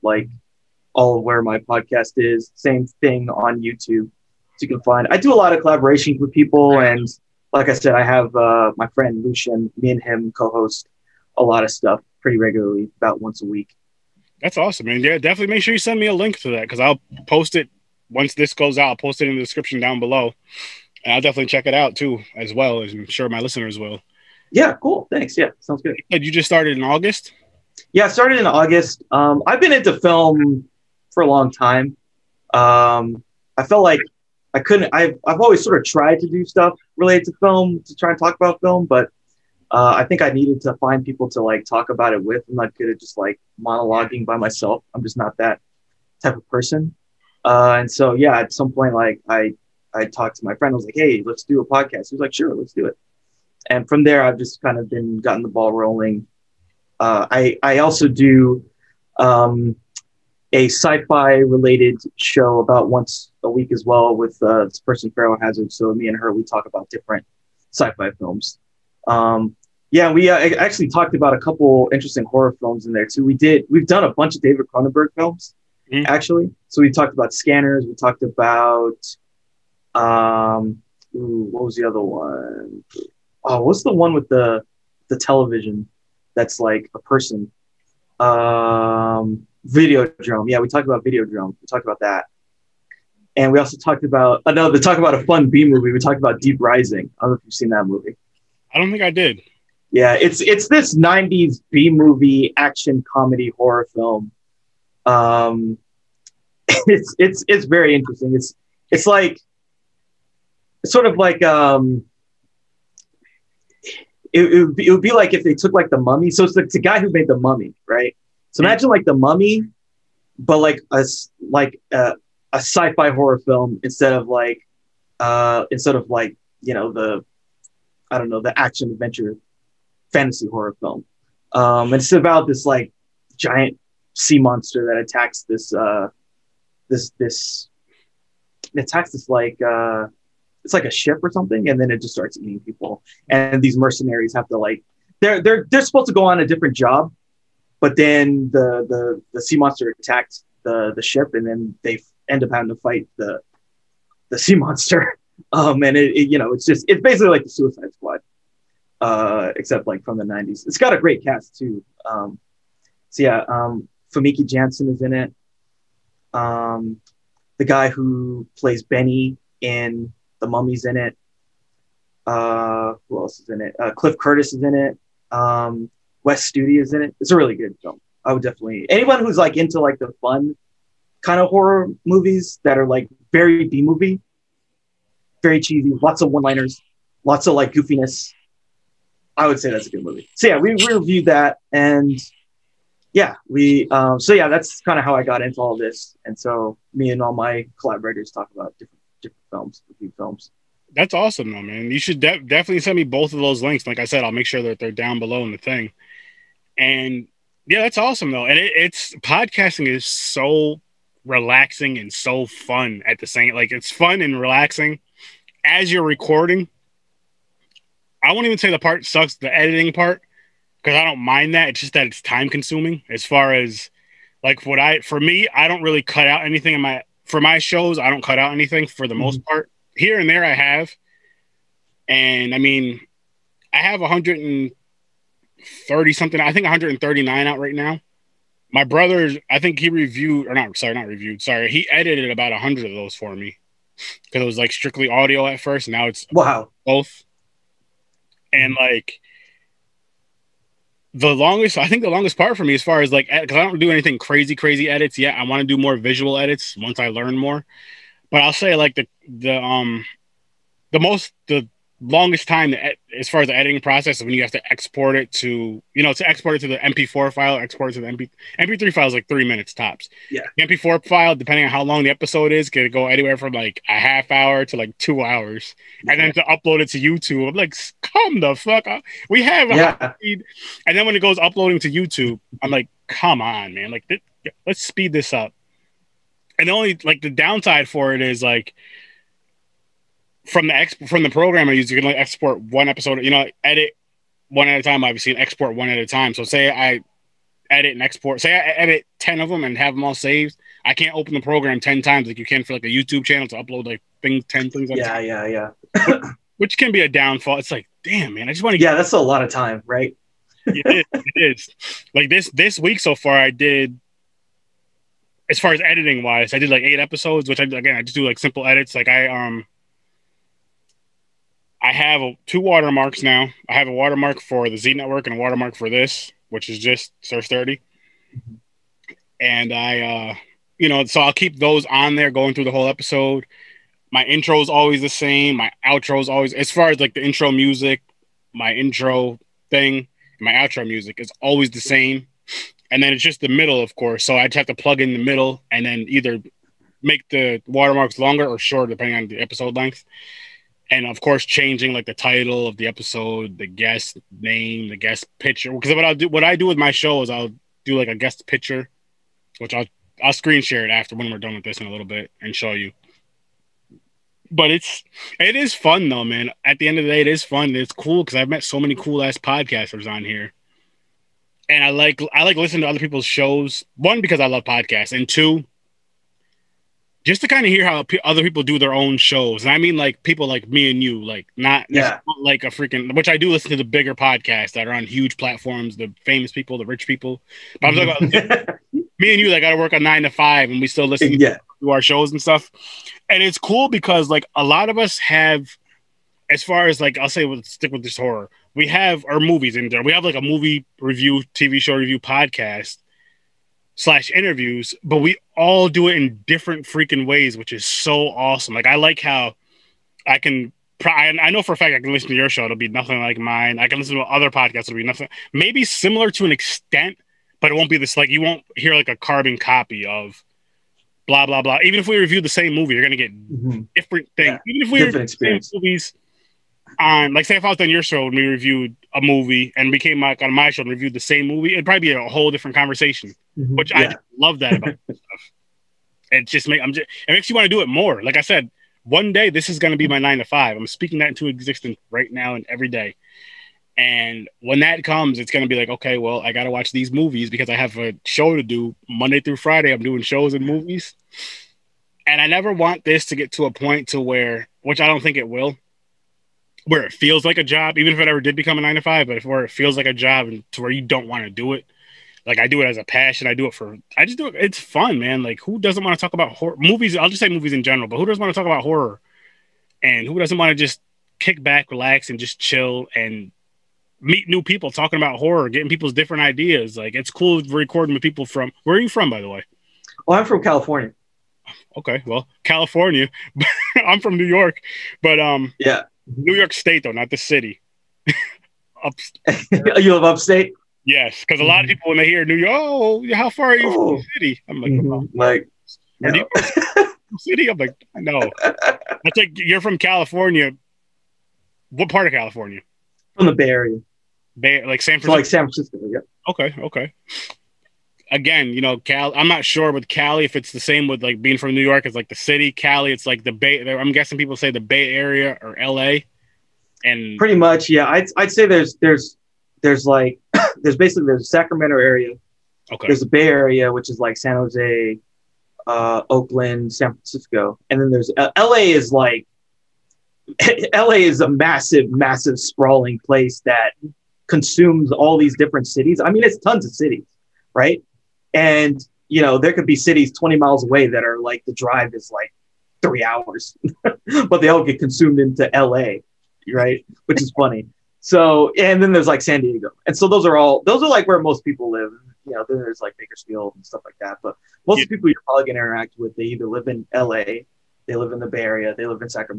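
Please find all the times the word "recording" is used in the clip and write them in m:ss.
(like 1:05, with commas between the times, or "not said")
3:36, 7:57.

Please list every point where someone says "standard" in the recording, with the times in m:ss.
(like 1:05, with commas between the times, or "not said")
not said.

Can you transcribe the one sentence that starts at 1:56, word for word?
So it's the, it's the guy who made the mummy, right?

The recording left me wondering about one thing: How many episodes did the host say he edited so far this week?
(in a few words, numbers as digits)
8.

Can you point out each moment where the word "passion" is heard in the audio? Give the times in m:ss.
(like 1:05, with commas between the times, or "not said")
7:43.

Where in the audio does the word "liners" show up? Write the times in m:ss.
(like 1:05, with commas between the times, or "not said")
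3:06.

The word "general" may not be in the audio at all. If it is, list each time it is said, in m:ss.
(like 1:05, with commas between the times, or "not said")
7:47.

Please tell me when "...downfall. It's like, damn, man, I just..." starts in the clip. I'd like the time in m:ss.
5:07.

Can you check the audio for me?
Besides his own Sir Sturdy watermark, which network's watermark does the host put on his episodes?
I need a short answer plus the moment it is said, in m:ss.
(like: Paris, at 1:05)
Z Network, at 5:24.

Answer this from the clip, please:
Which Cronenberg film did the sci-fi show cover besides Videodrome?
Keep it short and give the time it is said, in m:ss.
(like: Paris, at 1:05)
Scanners, at 1:17.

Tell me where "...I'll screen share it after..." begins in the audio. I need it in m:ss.
6:00.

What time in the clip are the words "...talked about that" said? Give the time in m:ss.
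1:31.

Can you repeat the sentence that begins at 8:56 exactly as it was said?
I mean, it's tons of cities, right?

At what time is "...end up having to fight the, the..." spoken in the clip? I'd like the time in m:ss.
2:32.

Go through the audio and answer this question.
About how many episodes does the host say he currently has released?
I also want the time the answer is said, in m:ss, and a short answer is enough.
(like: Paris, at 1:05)
139, at 3:56.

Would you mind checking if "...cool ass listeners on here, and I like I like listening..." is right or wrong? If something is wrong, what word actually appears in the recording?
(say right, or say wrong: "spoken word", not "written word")
wrong: "podcasters", not "listeners".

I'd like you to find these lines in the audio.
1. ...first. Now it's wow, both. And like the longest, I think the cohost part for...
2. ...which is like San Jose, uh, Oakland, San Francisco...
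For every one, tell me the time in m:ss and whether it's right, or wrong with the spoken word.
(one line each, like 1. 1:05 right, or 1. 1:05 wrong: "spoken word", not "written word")
1. 4:05 wrong: "longest", not "cohost"
2. 8:43 right.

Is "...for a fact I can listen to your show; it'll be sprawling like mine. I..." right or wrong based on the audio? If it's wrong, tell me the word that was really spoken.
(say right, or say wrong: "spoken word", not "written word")
wrong: "nothing", not "sprawling".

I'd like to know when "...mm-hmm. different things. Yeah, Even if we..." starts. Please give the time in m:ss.
7:03.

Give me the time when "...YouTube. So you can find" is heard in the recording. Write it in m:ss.
0:03.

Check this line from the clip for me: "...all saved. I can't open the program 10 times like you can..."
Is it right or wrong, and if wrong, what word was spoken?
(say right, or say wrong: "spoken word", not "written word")
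right.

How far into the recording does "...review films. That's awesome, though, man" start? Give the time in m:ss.
3:19.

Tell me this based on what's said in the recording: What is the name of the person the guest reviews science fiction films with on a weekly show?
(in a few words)
Pharaoh Hazard.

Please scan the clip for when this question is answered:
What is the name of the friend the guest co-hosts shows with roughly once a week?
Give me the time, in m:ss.
0:09.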